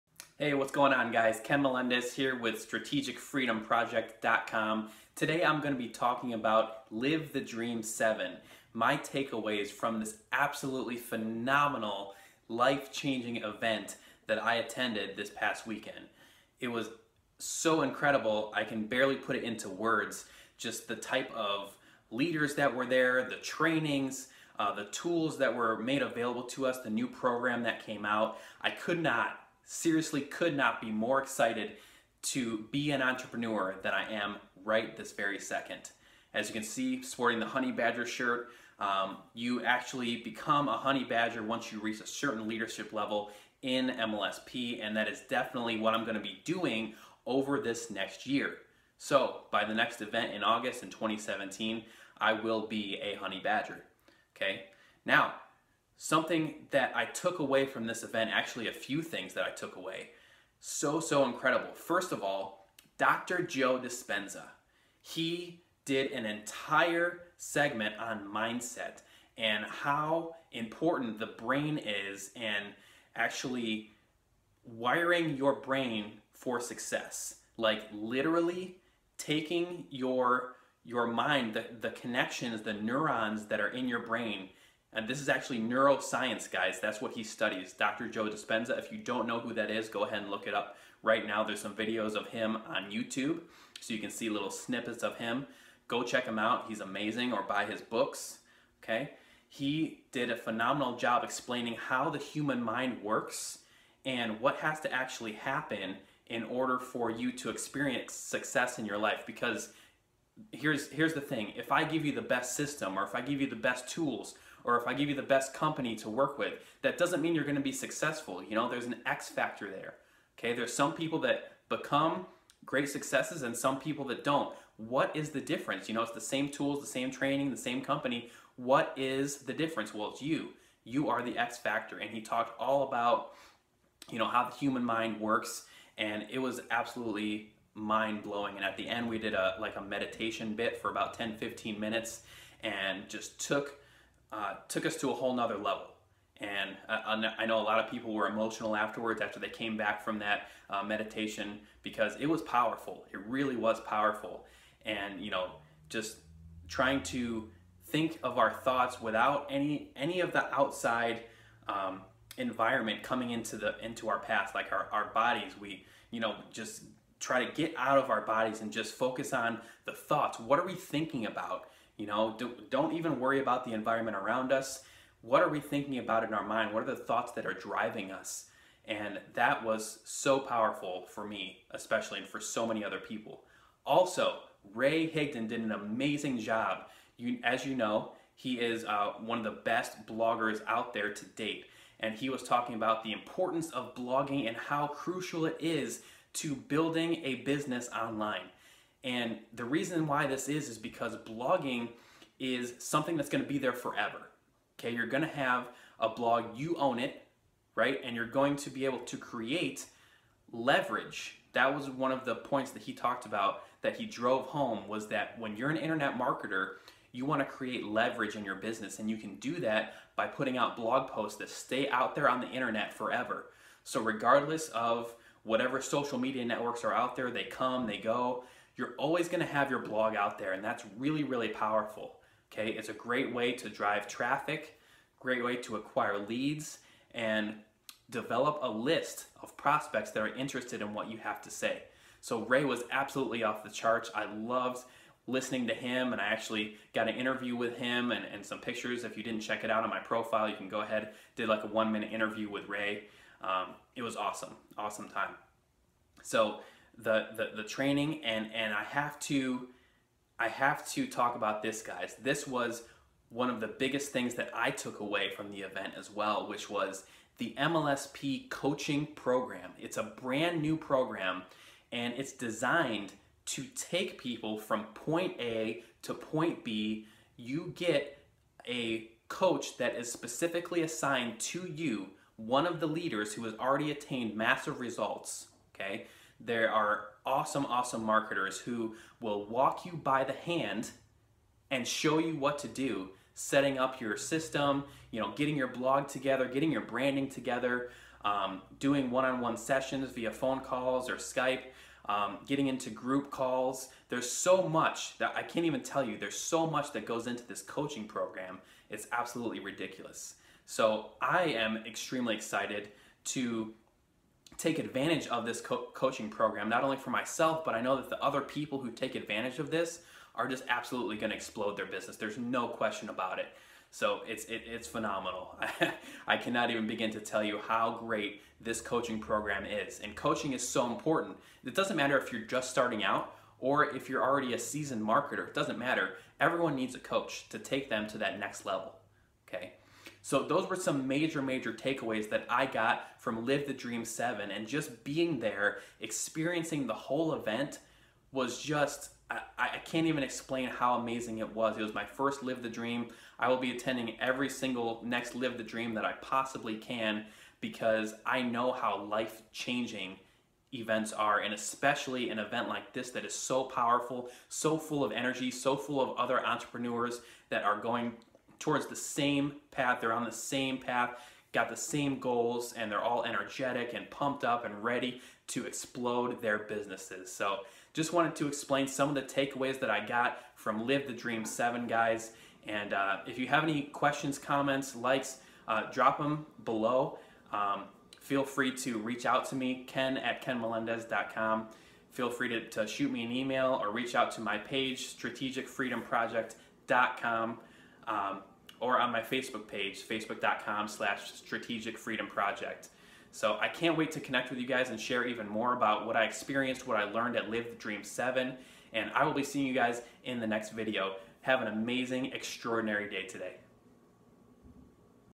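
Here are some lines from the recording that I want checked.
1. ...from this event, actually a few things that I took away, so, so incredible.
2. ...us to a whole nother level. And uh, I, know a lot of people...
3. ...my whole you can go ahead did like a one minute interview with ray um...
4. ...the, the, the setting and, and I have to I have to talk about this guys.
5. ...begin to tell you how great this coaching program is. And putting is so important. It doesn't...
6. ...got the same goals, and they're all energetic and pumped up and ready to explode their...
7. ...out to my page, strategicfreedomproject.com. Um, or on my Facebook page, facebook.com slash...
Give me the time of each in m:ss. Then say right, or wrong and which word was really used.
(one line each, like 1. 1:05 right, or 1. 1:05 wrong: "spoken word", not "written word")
1. 0:57 right
2. 2:24 right
3. 4:09 wrong: "profile", not "whole"
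4. 4:16 wrong: "training", not "setting"
5. 5:26 wrong: "coaching", not "putting"
6. 6:11 right
7. 6:34 right.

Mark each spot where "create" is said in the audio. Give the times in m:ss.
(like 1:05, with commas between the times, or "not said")
3:29, 3:37.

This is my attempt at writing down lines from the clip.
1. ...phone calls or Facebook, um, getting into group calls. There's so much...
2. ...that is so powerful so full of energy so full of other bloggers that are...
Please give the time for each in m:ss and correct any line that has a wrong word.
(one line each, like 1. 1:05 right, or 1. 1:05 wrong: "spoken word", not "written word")
1. 5:00 wrong: "Skype", not "Facebook"
2. 6:03 wrong: "entrepreneurs", not "bloggers".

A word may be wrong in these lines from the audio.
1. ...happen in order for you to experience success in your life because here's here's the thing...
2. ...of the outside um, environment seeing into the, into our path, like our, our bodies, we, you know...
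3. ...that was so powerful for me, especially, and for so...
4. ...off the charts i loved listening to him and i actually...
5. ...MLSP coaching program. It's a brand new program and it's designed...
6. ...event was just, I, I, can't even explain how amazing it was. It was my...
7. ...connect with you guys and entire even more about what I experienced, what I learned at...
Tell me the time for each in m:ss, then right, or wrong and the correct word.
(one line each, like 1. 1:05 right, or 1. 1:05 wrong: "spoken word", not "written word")
1. 1:45 right
2. 2:40 wrong: "coming", not "seeing"
3. 2:59 right
4. 4:03 right
5. 4:27 right
6. 5:47 right
7. 6:44 wrong: "share", not "entire".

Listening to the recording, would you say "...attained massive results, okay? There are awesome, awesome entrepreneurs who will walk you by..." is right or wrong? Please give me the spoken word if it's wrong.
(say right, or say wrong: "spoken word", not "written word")
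wrong: "marketers", not "entrepreneurs".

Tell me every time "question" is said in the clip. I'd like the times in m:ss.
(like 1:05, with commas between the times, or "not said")
5:22, 6:23.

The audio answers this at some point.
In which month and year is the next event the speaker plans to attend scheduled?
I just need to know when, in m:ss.
0:50.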